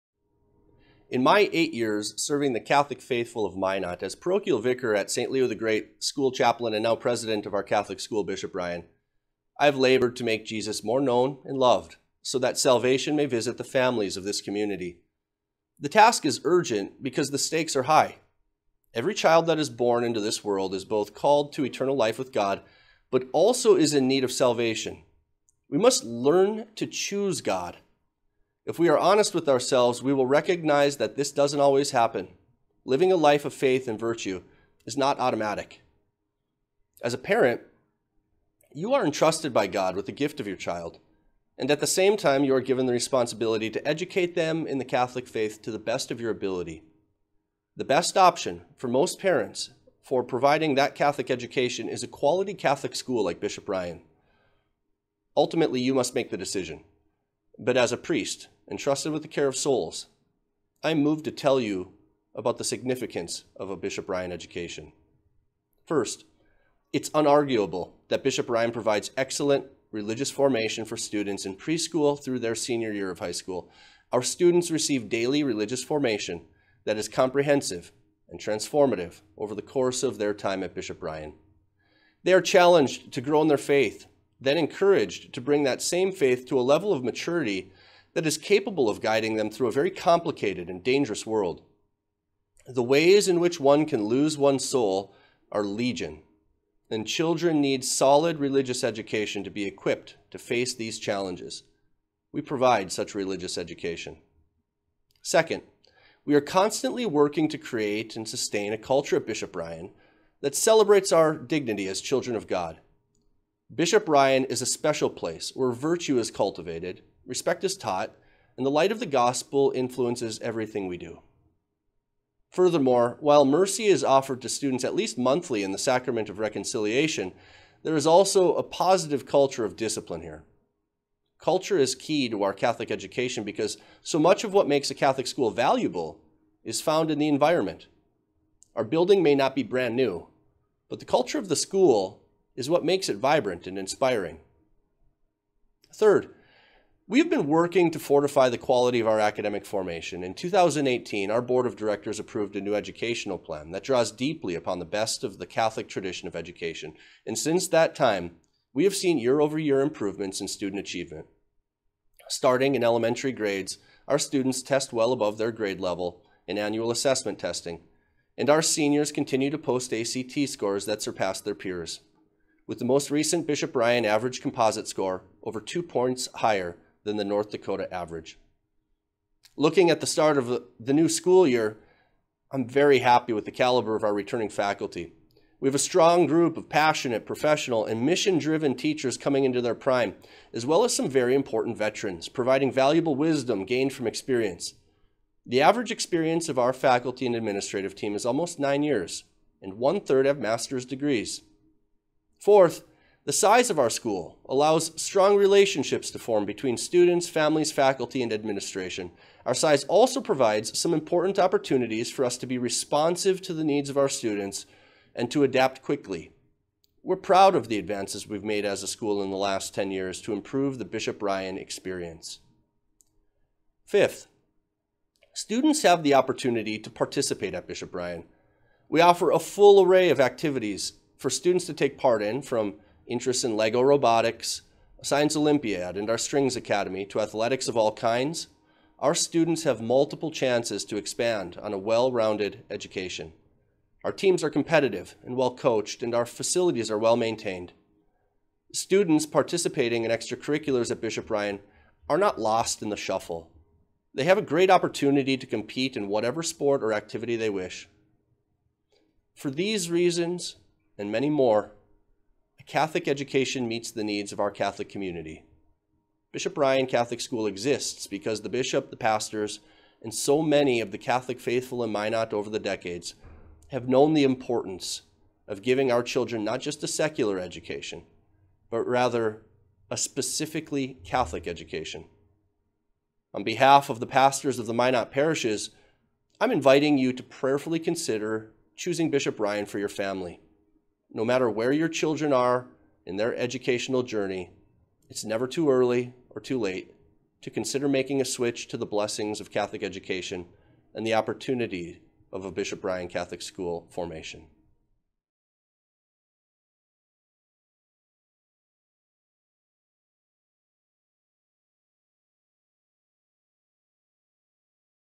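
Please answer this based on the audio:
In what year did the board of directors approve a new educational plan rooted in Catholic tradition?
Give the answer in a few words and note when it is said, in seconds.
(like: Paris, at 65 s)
2018, at 150 s.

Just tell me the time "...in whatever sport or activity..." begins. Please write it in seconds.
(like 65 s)
255 s.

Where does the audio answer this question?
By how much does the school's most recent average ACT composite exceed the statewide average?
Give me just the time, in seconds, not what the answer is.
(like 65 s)
175 s.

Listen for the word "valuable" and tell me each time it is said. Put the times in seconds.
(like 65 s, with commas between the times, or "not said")
135 s, 192 s.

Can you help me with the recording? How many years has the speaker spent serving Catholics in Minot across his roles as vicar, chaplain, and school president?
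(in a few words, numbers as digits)
8.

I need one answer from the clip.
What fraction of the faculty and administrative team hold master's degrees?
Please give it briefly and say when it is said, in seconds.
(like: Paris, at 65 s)
One third, at 199 s.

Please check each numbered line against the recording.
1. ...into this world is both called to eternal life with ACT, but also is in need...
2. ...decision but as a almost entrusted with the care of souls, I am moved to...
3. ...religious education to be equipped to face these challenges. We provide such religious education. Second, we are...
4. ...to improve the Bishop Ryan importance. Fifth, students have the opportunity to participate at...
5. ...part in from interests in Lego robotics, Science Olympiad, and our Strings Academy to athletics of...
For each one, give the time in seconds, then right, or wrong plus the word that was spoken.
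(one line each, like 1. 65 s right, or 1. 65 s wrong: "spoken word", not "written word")
1. 20 s wrong: "God", not "ACT"
2. 56 s wrong: "priest", not "almost"
3. 98 s right
4. 220 s wrong: "experience", not "importance"
5. 231 s right.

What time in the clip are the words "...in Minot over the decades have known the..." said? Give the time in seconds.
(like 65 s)
271 s.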